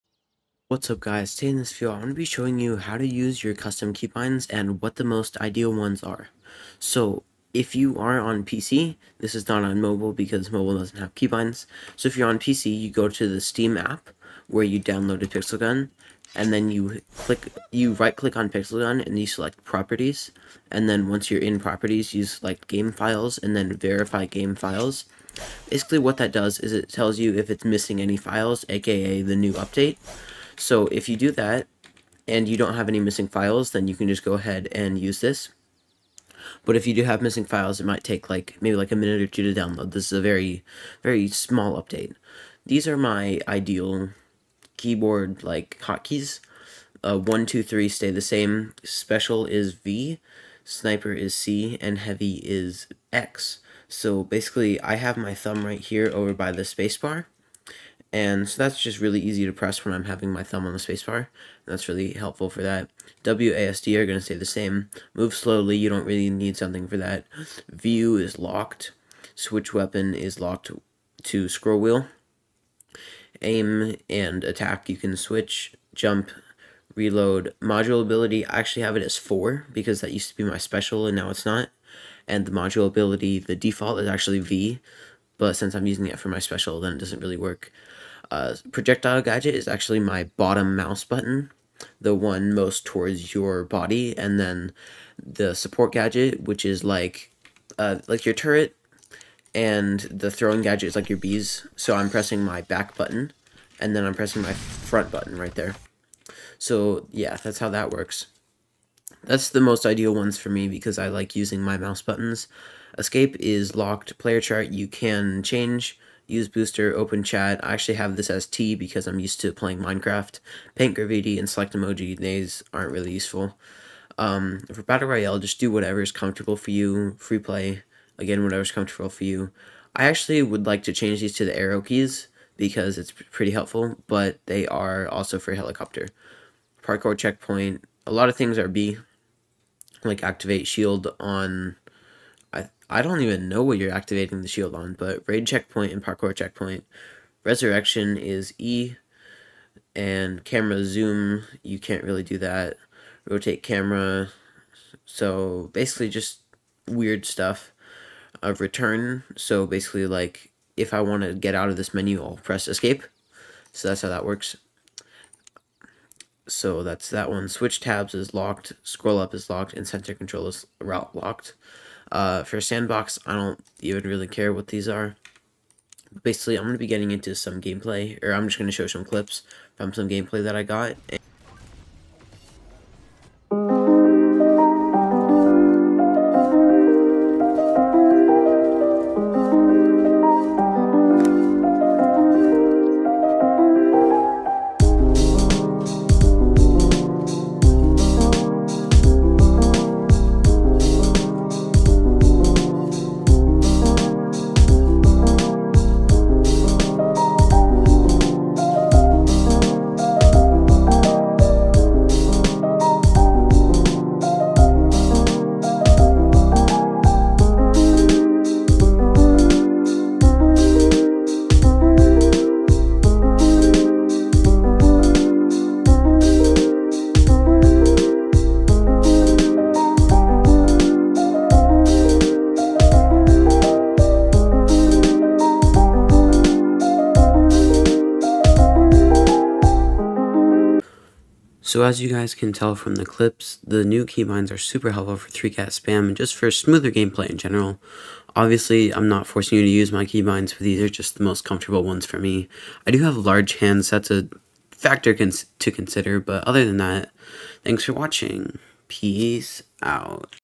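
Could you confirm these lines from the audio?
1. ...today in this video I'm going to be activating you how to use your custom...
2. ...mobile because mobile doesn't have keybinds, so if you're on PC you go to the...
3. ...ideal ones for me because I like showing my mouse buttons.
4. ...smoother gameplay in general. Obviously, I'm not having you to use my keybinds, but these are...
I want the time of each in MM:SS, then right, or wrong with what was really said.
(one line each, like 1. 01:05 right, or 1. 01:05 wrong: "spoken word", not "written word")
1. 00:01 wrong: "showing", not "activating"
2. 00:09 right
3. 01:49 wrong: "using", not "showing"
4. 04:06 wrong: "forcing", not "having".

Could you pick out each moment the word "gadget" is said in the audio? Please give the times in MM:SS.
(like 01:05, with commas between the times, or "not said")
01:29, 01:35, 01:40.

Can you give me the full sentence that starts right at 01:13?
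Aim and attack you can switch.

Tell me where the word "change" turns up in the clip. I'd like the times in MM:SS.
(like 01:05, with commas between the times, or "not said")
01:55, 02:10.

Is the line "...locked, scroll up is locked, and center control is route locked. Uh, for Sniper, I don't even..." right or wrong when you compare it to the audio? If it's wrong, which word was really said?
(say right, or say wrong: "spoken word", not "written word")
wrong: "Sandbox", not "Sniper".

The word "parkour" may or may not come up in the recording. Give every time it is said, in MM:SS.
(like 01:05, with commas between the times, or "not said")
02:16, 02:26.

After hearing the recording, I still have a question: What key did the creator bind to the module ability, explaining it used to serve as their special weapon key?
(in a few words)
4.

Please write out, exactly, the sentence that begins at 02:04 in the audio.
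Um, for Battle Royale, just do whatever is comfortable for you.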